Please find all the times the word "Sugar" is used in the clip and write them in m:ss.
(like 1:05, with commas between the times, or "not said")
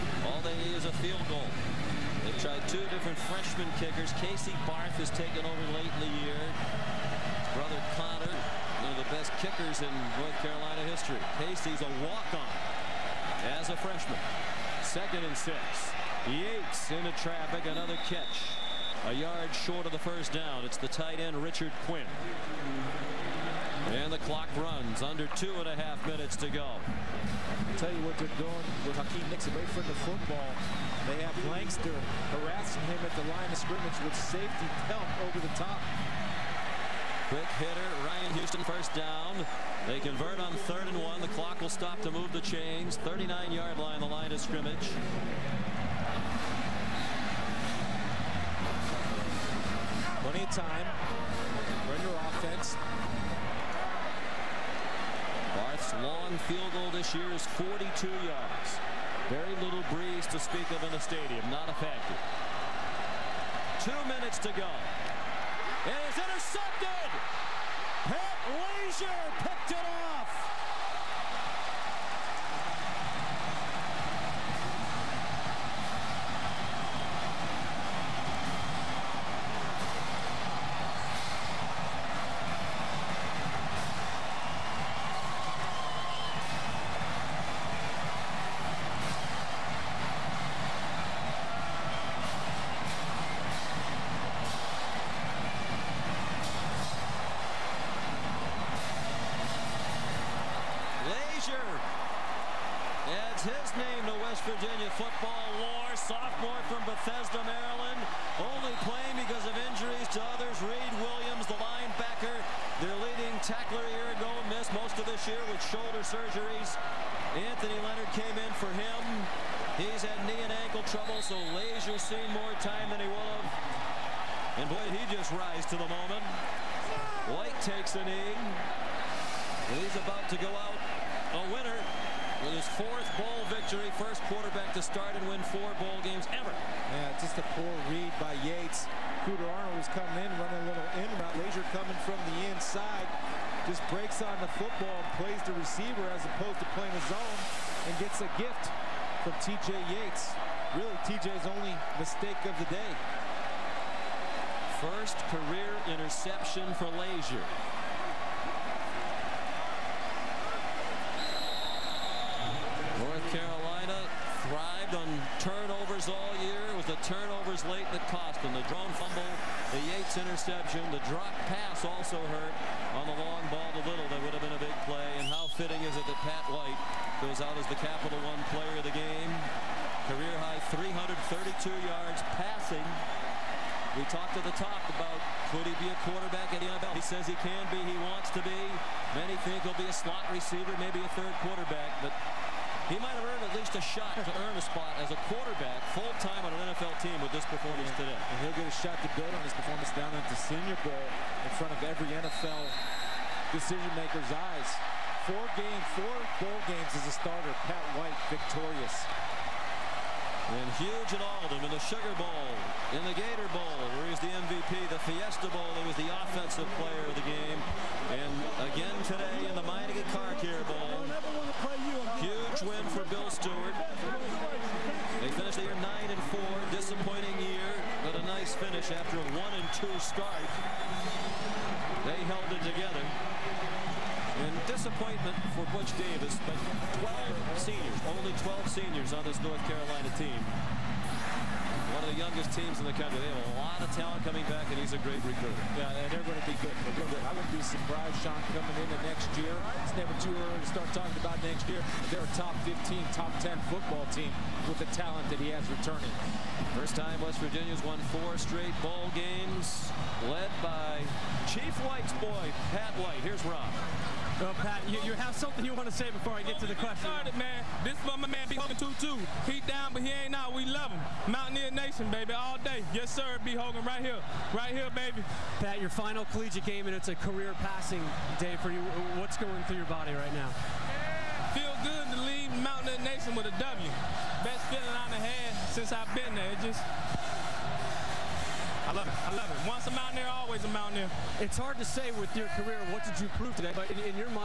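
3:31.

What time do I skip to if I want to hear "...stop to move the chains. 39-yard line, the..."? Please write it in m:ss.
0:41.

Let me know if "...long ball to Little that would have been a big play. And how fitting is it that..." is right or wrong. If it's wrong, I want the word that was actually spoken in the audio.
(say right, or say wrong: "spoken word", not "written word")
right.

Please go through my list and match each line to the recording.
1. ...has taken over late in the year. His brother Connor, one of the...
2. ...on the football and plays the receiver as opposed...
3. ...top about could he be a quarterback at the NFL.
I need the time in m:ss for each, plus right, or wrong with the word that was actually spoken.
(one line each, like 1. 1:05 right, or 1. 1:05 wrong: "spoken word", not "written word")
1. 0:05 right
2. 2:24 right
3. 3:04 right.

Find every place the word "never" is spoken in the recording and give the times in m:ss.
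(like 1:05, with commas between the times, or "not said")
4:09.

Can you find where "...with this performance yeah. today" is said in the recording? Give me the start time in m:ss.
3:17.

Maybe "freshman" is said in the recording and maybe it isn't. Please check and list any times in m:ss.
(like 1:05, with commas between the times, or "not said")
0:03, 0:13.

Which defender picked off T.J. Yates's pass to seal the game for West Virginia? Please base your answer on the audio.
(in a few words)
Pat Lazear.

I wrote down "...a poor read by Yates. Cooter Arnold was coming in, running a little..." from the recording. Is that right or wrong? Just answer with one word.
right.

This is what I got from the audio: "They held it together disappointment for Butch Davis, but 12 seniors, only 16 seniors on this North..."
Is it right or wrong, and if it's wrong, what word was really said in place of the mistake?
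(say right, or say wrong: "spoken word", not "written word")
wrong: "12", not "16".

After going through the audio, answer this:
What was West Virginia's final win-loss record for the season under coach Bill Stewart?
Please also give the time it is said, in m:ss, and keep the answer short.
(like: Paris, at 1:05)
9 and 4, at 3:45.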